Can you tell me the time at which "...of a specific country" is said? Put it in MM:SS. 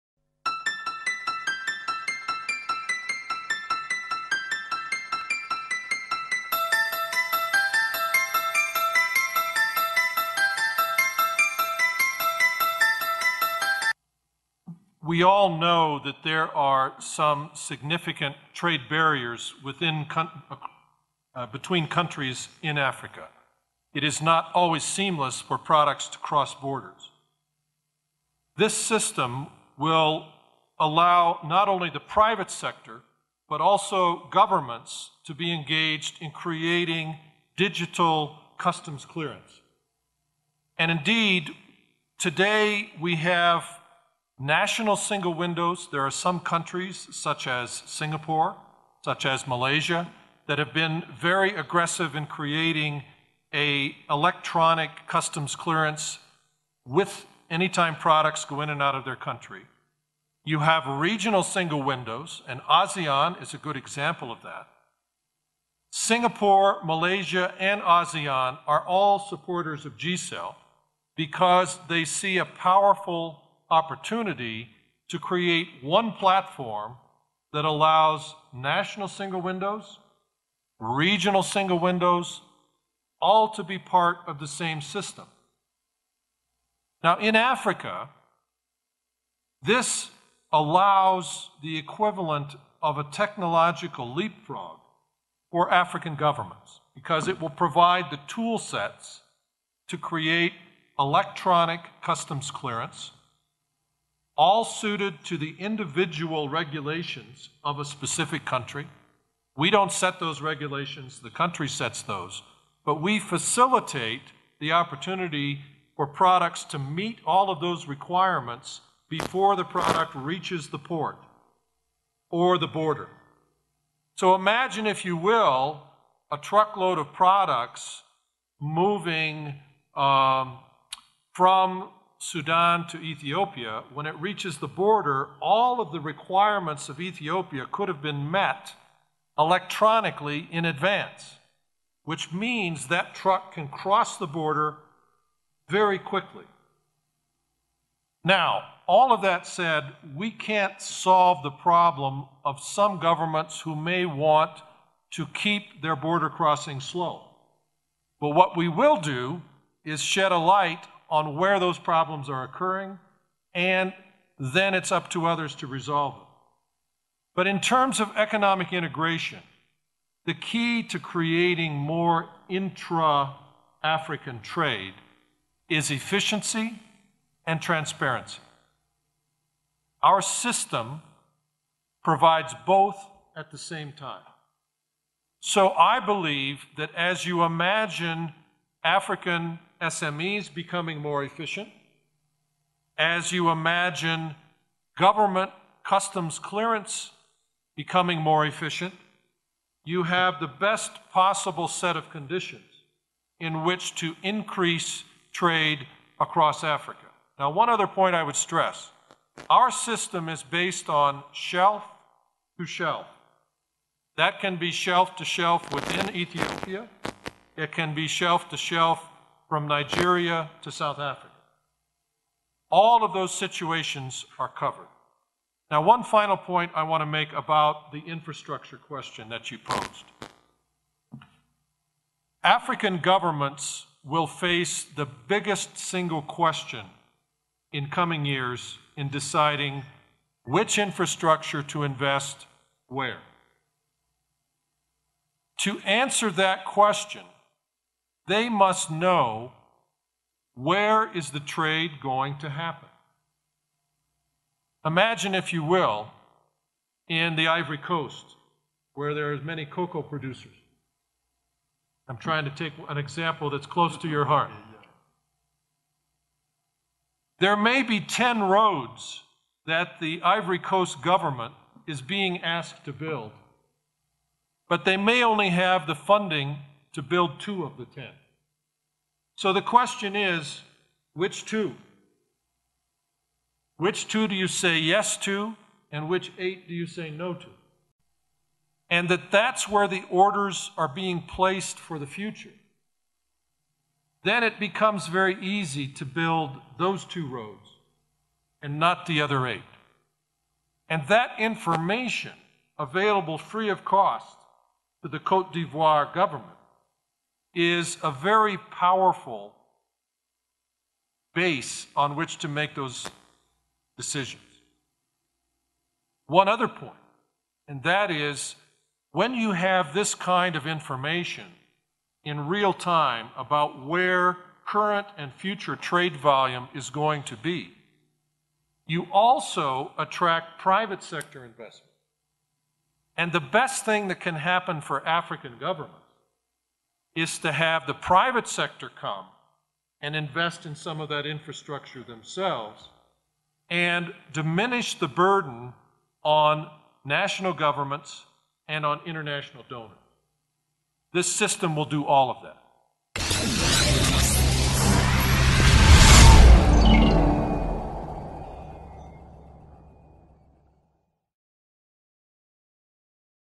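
01:47.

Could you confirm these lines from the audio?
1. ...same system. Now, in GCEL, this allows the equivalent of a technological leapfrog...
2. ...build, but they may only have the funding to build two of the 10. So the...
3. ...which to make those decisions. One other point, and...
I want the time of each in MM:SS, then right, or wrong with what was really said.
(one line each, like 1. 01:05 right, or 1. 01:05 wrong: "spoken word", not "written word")
1. 01:24 wrong: "Africa", not "GCEL"
2. 04:32 right
3. 05:12 right.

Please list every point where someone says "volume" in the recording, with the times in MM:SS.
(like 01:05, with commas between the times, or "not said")
05:26.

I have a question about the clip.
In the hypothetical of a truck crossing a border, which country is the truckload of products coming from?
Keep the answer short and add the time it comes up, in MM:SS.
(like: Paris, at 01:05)
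Sudan, at 02:12.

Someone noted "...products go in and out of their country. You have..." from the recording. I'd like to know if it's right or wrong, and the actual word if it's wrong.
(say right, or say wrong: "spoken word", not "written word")
right.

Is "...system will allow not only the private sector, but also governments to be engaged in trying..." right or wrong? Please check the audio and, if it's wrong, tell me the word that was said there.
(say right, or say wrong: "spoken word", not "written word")
wrong: "creating", not "trying".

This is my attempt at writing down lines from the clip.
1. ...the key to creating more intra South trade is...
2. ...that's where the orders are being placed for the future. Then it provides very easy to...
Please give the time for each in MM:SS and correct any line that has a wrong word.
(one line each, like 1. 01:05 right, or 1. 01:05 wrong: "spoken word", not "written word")
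1. 02:50 wrong: "African", not "South"
2. 04:49 wrong: "becomes", not "provides".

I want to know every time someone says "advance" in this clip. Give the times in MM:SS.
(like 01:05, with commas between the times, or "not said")
02:20.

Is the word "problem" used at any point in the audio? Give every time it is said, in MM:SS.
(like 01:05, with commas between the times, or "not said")
02:31, 02:41.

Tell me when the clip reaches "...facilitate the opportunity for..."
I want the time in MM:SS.
01:53.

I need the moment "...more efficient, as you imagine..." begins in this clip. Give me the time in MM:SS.
03:10.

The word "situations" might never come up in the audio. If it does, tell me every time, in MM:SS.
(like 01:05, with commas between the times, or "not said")
03:43.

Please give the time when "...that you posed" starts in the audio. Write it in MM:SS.
03:49.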